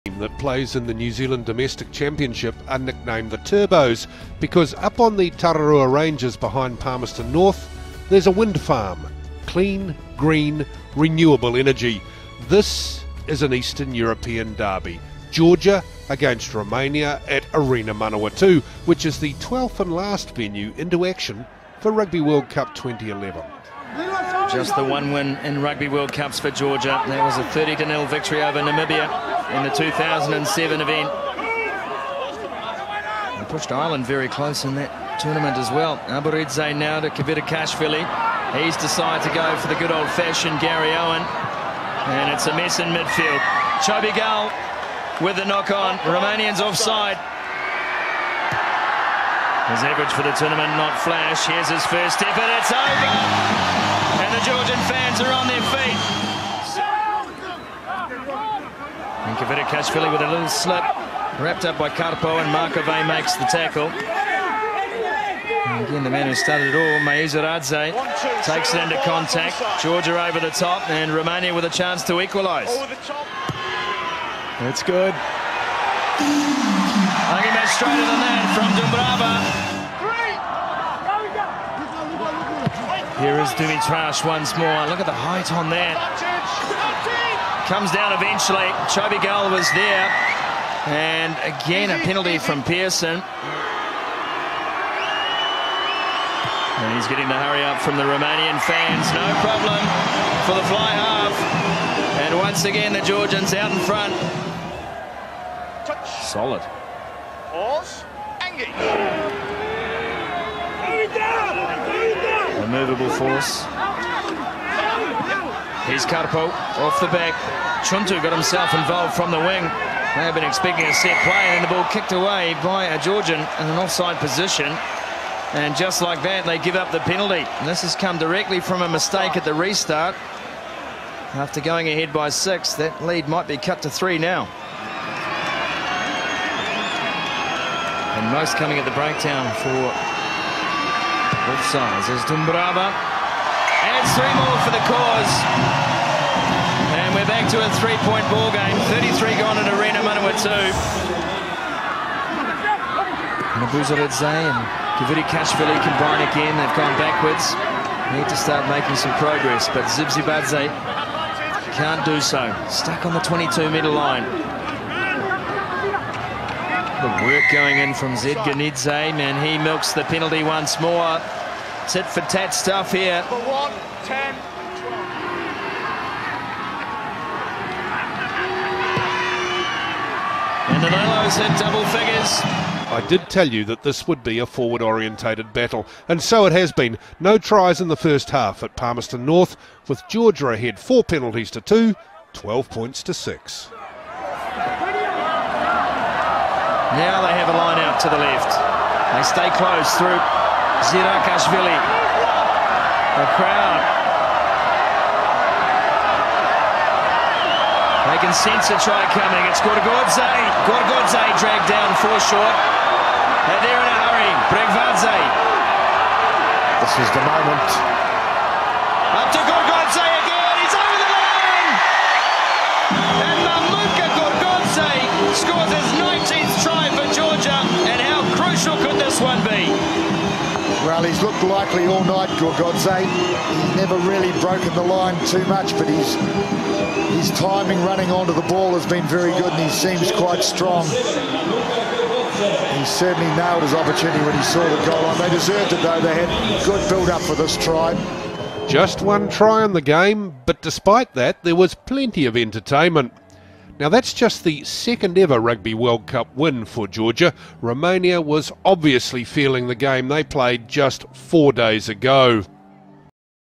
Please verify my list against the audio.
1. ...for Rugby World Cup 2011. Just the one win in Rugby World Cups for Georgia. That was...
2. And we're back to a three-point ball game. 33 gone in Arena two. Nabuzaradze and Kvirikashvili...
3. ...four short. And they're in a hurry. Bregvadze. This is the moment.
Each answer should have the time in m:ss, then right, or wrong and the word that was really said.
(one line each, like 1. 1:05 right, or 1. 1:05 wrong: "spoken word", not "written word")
1. 0:21 right
2. 2:27 right
3. 3:32 right.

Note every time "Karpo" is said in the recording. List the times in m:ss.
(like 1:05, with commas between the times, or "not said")
1:01, 1:56.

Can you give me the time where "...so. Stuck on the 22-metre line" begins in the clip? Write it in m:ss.
2:42.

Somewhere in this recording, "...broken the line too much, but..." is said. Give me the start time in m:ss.
3:54.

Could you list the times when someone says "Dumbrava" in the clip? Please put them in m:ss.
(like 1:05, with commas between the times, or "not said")
1:23, 2:22.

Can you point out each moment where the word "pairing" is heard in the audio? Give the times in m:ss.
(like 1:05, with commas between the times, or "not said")
not said.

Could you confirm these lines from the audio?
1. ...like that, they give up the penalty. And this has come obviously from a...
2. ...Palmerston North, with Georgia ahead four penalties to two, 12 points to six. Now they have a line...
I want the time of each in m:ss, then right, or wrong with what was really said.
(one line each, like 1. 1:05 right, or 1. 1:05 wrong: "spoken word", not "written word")
1. 2:06 wrong: "directly", not "obviously"
2. 3:08 right.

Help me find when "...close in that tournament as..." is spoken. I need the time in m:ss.
0:34.